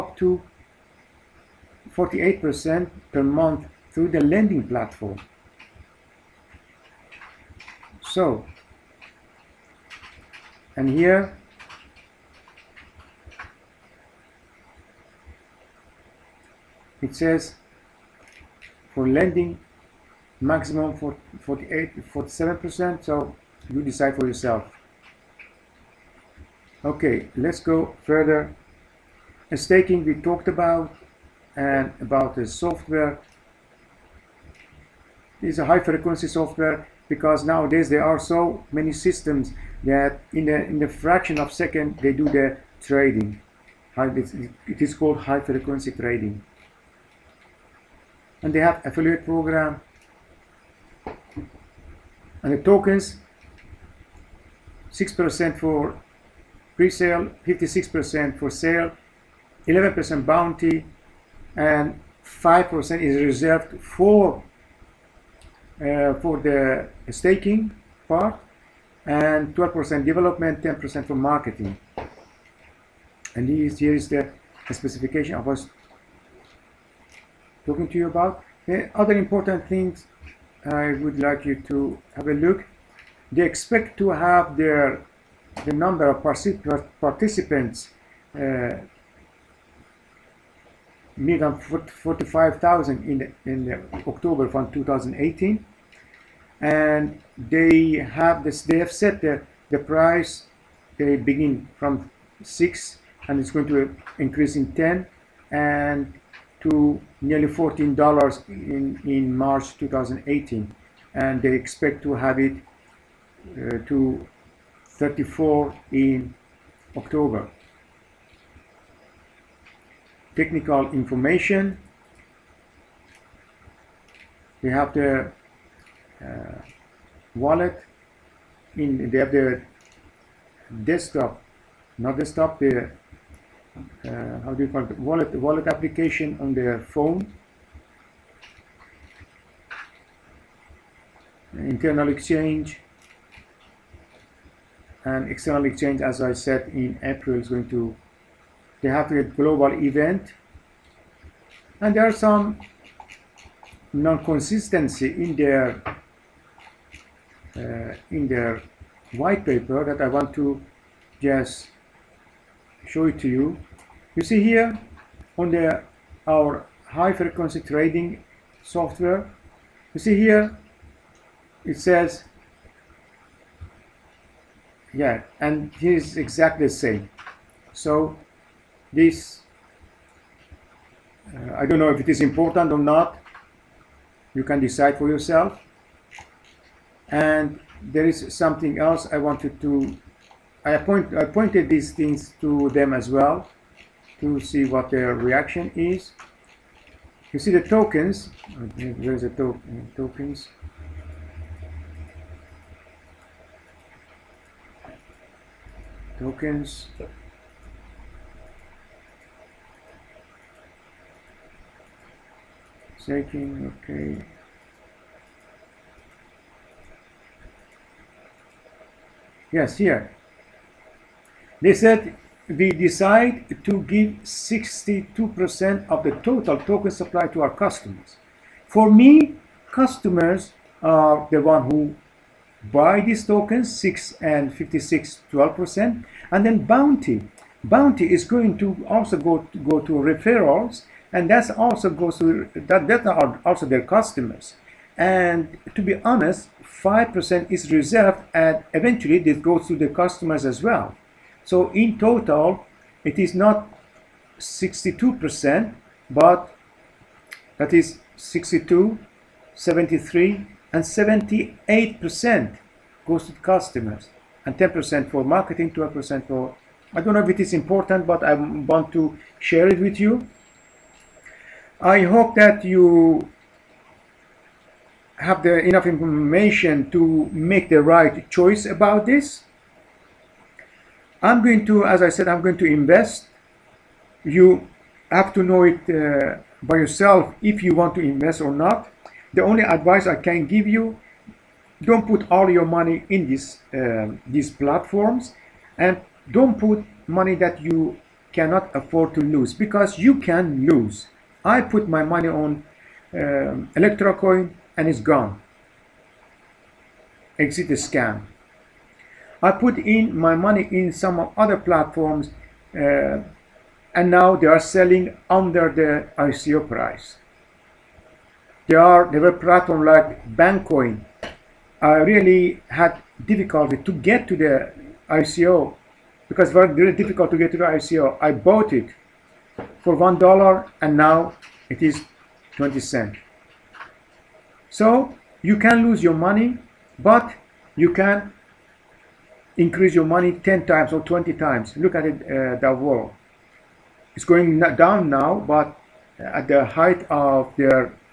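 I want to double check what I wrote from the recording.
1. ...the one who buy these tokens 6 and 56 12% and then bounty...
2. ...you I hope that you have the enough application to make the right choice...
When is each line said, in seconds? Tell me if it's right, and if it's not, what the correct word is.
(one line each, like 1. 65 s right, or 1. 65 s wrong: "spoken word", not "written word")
1. 231 s right
2. 269 s wrong: "information", not "application".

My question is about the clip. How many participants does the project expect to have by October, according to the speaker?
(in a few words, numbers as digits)
45,000.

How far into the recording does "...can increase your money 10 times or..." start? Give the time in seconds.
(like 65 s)
337 s.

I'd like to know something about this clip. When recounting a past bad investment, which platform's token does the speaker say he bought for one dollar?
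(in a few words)
Bankcoin.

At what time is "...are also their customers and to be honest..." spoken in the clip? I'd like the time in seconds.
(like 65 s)
243 s.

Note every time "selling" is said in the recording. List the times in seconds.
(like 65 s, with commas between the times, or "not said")
314 s.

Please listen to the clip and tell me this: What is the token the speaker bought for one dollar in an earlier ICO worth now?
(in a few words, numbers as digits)
20 cents.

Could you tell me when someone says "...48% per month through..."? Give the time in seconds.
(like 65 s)
1 s.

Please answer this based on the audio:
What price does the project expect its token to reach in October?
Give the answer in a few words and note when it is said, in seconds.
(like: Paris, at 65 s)
34 dollars, at 114 s.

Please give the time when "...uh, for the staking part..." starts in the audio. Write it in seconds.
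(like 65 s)
65 s.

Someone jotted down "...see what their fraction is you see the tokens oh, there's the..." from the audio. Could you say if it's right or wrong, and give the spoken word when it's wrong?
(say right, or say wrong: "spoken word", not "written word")
wrong: "reaction", not "fraction".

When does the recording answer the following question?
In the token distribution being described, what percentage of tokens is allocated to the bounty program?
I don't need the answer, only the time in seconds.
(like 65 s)
59 s.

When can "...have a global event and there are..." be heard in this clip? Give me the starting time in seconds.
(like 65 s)
148 s.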